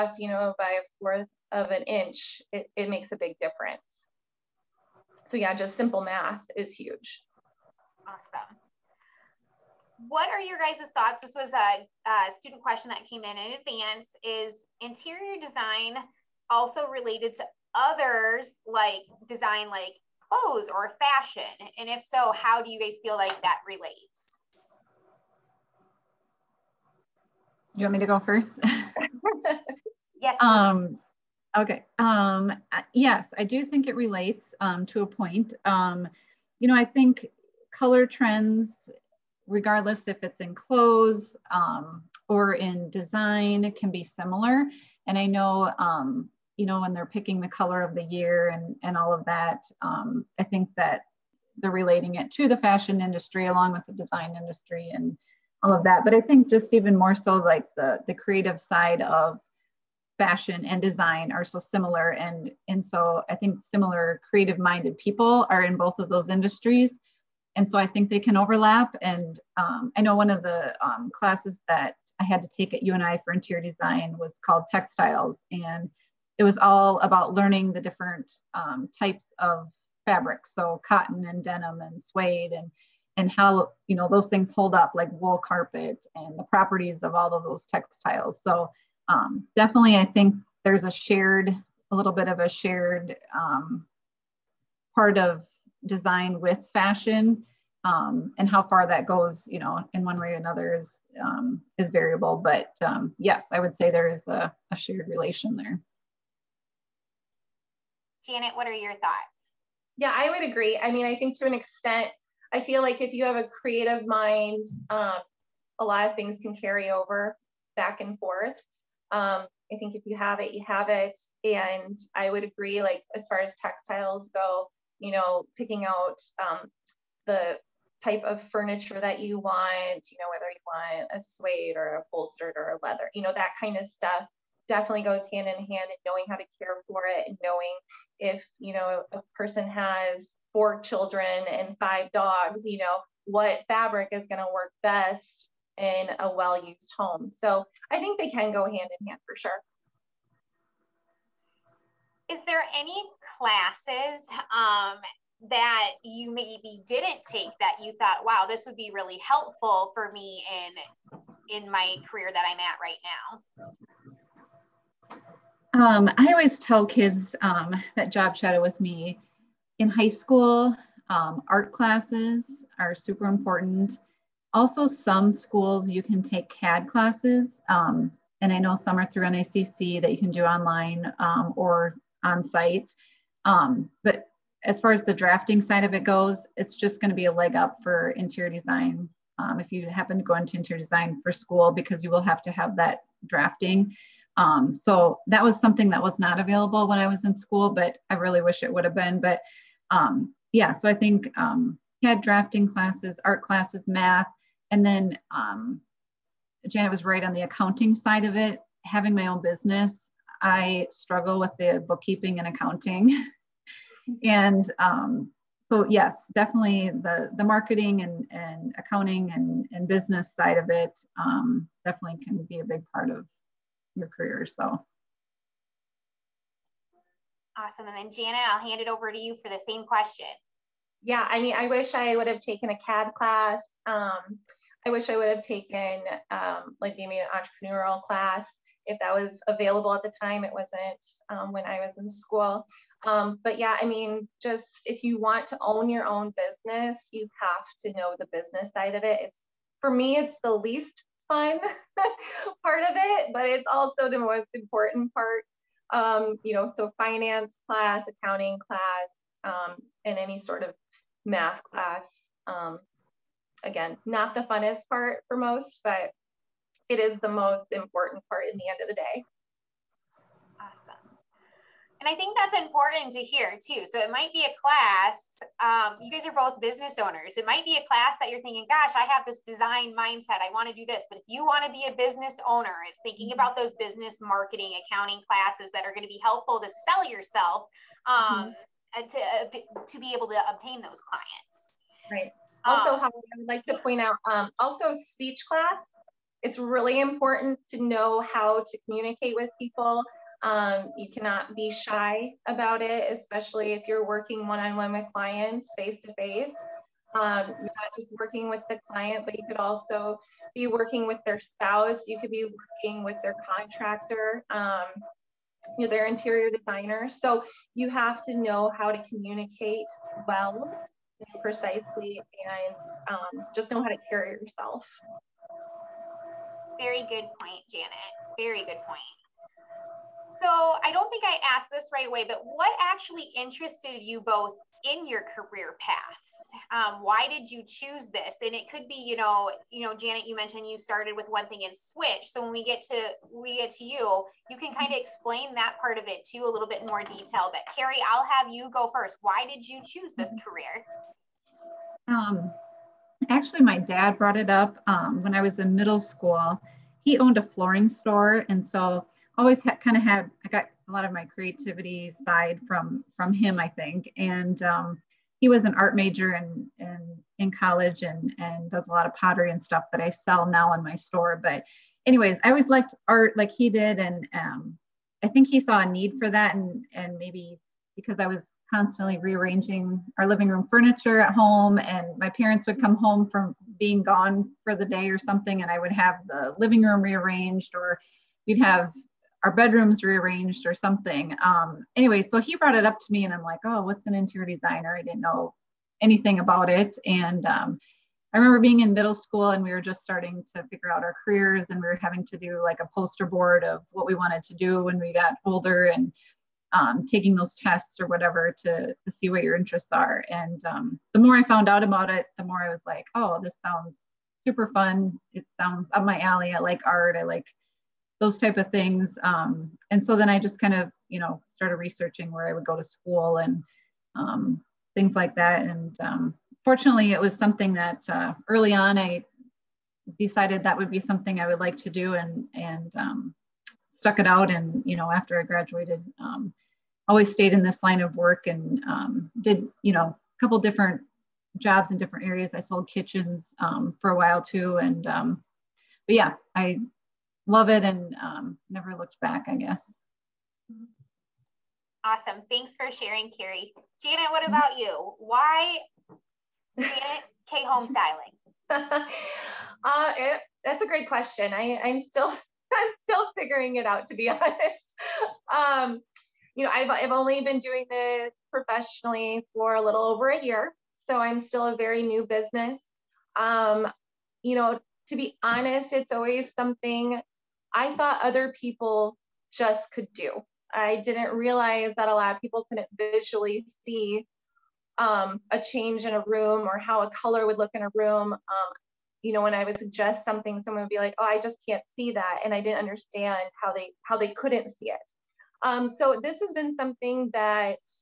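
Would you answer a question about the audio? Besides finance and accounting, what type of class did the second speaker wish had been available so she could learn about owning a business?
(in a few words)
Entrepreneurial class.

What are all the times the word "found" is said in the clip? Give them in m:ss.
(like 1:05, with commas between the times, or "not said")
6:51.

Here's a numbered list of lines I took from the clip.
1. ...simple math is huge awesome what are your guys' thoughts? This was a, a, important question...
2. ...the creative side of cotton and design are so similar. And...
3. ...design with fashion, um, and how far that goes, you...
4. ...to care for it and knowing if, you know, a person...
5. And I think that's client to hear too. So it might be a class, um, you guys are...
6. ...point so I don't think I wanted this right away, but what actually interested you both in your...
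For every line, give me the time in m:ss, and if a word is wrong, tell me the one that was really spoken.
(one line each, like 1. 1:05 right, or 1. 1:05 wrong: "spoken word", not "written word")
1. 0:05 wrong: "student", not "important"
2. 0:58 wrong: "fashion", not "cotton"
3. 1:35 right
4. 2:16 right
5. 4:32 wrong: "important", not "client"
6. 5:28 wrong: "asked", not "wanted".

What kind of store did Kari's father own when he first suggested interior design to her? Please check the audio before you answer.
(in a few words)
Flooring store.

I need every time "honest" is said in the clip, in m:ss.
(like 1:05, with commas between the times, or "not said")
7:44, 7:55.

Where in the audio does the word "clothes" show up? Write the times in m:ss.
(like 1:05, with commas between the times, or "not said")
0:20, 0:40.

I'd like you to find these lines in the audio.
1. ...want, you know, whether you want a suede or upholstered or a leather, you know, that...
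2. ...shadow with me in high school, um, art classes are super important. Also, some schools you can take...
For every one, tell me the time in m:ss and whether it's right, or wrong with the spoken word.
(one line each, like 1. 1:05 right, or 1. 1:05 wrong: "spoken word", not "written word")
1. 2:09 right
2. 2:48 right.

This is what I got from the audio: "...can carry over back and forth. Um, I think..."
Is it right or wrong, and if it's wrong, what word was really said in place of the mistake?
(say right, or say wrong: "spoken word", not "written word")
right.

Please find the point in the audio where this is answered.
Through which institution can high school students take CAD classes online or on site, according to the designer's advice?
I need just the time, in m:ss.
2:59.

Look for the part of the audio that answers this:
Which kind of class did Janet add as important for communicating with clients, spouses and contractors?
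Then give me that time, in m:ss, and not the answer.
4:54.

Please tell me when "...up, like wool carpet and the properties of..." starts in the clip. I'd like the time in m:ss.
1:24.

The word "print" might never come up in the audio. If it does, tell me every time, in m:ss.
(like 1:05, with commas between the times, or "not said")
not said.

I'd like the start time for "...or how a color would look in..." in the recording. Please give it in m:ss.
8:06.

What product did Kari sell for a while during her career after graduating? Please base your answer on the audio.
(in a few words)
Kitchens.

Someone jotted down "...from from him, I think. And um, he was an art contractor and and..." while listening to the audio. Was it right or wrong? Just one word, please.
wrong.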